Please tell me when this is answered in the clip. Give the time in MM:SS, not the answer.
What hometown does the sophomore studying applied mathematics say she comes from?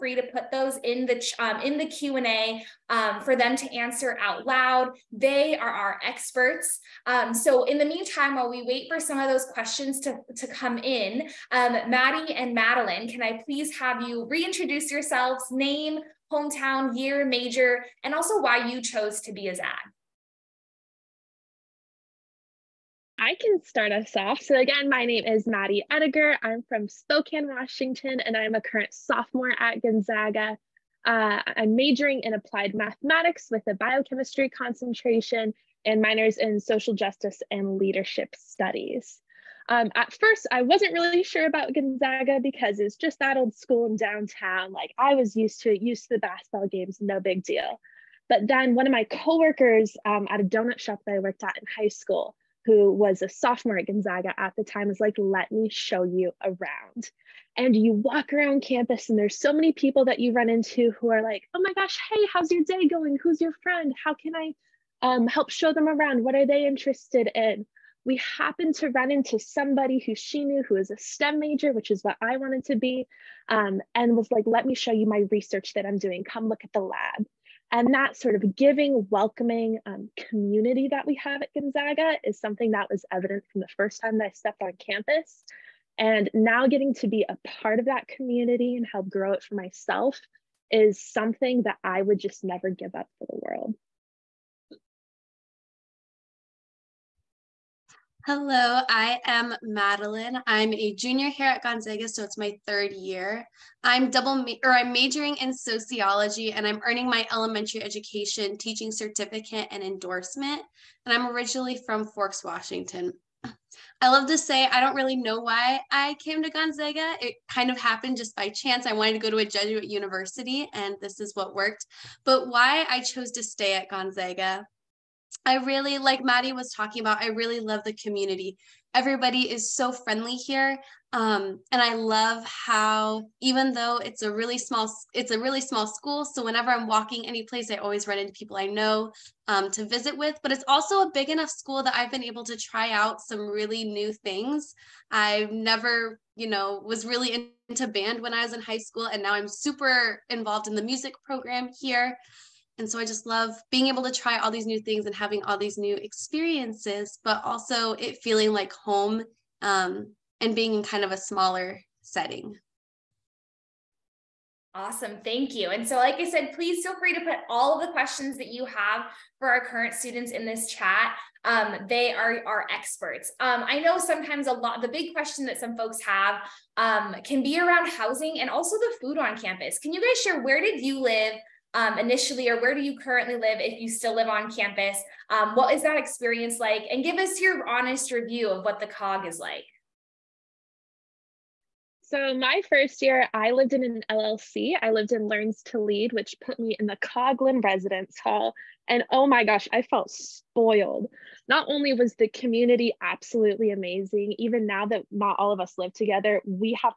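00:26.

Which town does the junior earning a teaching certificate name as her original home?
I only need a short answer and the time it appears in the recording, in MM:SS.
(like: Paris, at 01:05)
Forks, Washington, at 01:52.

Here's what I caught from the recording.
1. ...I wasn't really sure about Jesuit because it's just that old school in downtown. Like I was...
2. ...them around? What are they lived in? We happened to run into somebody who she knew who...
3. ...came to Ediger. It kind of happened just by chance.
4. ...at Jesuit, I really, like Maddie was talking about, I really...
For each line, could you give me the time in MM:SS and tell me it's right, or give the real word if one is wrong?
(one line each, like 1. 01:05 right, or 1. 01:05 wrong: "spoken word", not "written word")
1. 00:40 wrong: "Gonzaga", not "Jesuit"
2. 01:05 wrong: "interested", not "lived"
3. 01:56 wrong: "Gonzaga", not "Ediger"
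4. 02:03 wrong: "Gonzaga", not "Jesuit".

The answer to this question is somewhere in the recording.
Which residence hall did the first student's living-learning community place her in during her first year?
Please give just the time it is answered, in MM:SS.
03:16.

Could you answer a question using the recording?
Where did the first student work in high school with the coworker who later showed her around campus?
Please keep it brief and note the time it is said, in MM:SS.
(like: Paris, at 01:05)
a donut shop, at 00:50.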